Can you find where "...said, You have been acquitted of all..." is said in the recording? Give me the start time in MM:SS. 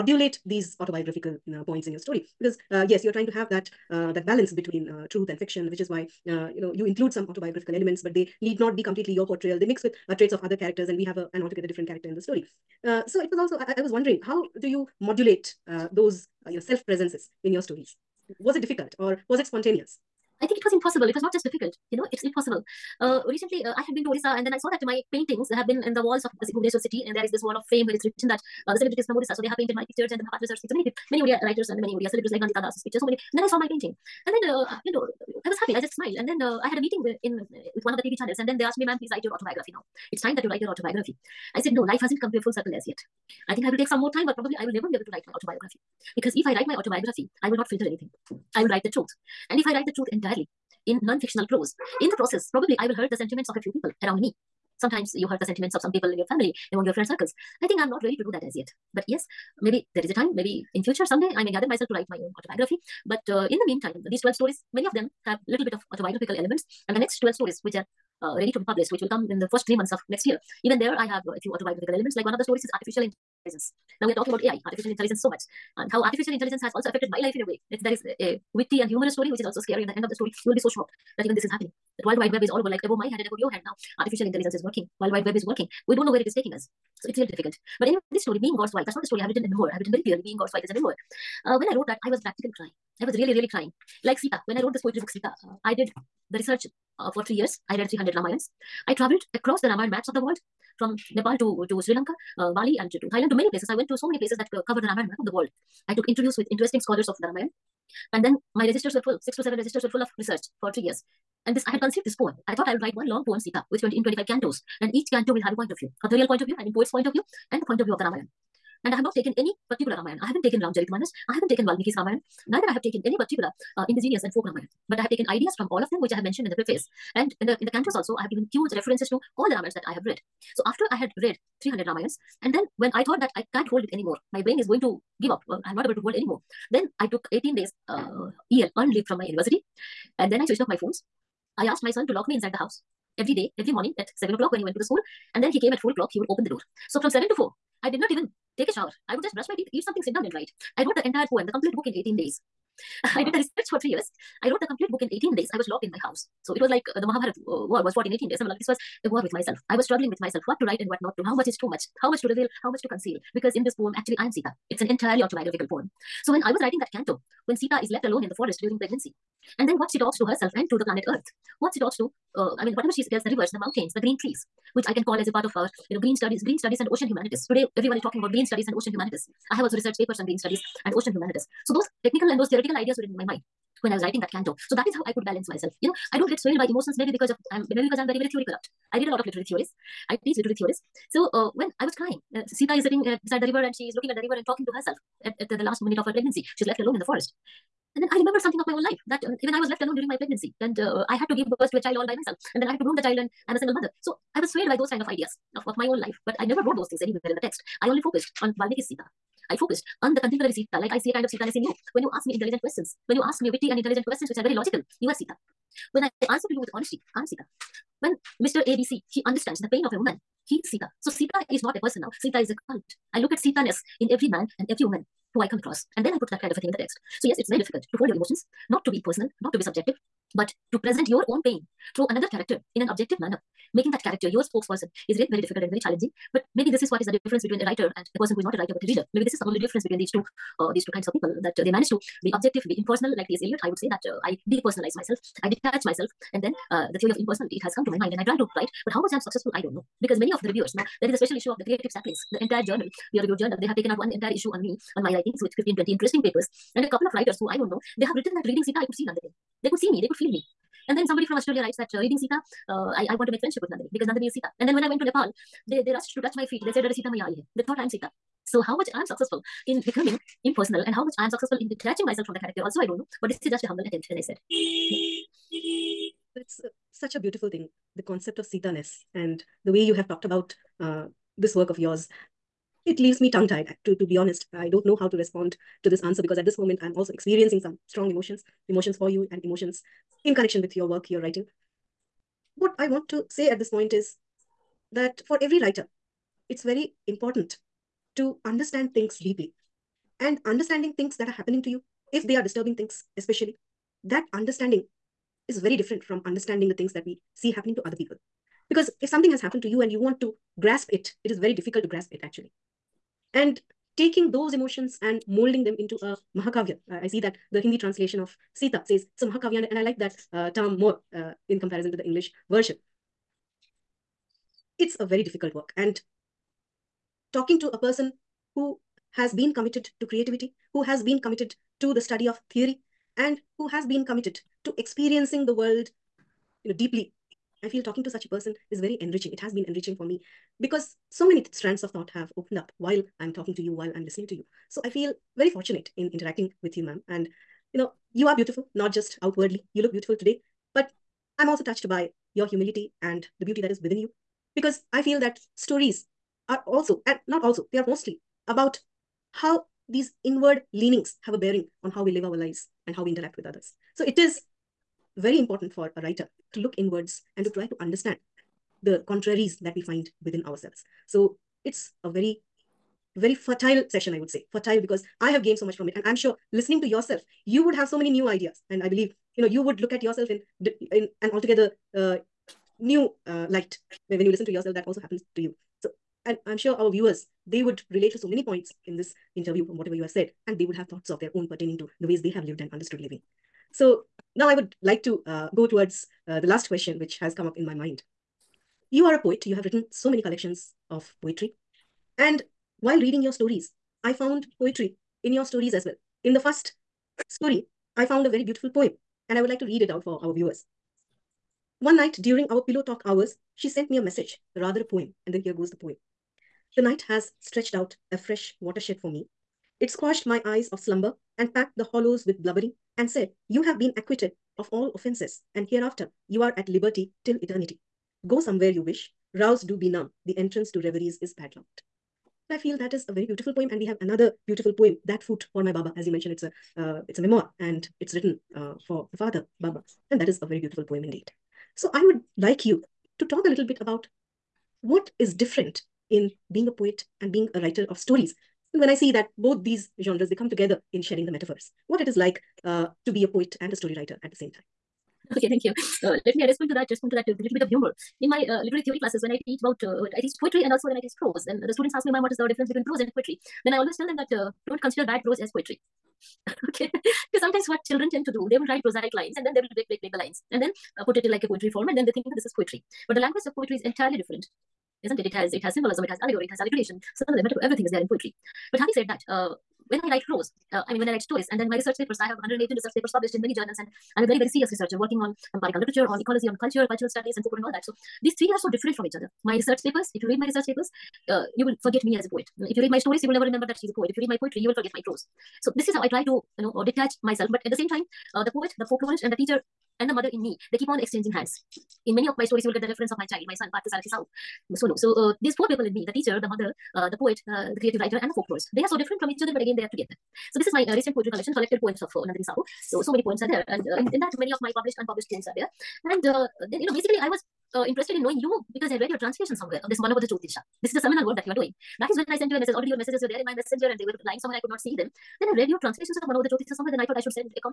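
07:03.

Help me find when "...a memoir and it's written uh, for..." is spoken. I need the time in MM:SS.
07:17.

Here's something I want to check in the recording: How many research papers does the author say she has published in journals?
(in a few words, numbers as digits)
118.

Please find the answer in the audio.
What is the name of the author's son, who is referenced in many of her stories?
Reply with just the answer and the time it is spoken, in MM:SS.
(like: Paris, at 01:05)
Partha Sarathi Sahu, at 08:23.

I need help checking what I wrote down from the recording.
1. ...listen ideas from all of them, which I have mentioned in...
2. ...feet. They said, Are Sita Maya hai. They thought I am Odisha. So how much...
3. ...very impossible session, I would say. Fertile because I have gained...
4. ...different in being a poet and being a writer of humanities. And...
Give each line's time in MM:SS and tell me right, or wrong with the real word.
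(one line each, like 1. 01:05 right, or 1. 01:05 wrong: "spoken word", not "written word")
1. 02:05 wrong: "taken", not "listen"
2. 04:26 wrong: "Sita", not "Odisha"
3. 06:13 wrong: "fertile", not "impossible"
4. 07:25 wrong: "stories", not "humanities".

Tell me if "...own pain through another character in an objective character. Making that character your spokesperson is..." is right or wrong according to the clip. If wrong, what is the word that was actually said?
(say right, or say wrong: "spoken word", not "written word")
wrong: "manner", not "character".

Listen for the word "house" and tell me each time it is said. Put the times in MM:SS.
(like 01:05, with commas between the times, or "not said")
02:22, 02:36.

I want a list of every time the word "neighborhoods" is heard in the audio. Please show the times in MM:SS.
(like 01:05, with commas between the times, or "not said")
not said.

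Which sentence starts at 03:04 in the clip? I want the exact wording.
So that is how I could balance myself.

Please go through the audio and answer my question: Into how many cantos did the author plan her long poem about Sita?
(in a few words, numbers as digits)
25.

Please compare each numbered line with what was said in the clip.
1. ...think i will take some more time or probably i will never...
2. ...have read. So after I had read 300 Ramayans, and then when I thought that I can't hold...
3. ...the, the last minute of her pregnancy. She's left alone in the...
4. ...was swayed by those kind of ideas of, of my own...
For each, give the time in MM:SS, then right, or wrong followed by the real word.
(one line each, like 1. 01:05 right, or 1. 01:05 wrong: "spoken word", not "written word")
1. 00:43 right
2. 02:09 right
3. 03:15 right
4. 03:24 right.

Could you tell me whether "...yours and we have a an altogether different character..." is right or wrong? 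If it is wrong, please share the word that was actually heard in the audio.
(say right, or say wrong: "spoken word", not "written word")
wrong: "characters", not "yours".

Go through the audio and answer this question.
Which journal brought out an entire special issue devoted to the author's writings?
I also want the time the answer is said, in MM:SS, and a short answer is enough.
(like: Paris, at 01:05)
Creative Saplings, at 04:11.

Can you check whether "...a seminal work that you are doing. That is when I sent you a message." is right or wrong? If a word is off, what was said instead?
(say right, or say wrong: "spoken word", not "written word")
right.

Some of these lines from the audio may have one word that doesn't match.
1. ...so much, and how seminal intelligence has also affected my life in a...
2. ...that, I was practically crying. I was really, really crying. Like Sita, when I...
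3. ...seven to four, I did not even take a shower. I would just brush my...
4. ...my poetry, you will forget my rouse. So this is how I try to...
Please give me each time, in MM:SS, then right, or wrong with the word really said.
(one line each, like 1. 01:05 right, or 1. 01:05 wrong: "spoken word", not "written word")
1. 01:15 wrong: "artificial", not "seminal"
2. 01:31 right
3. 02:27 right
4. 08:14 wrong: "prose", not "rouse".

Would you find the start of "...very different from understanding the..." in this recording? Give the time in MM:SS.
05:05.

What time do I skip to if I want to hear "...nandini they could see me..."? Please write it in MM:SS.
04:19.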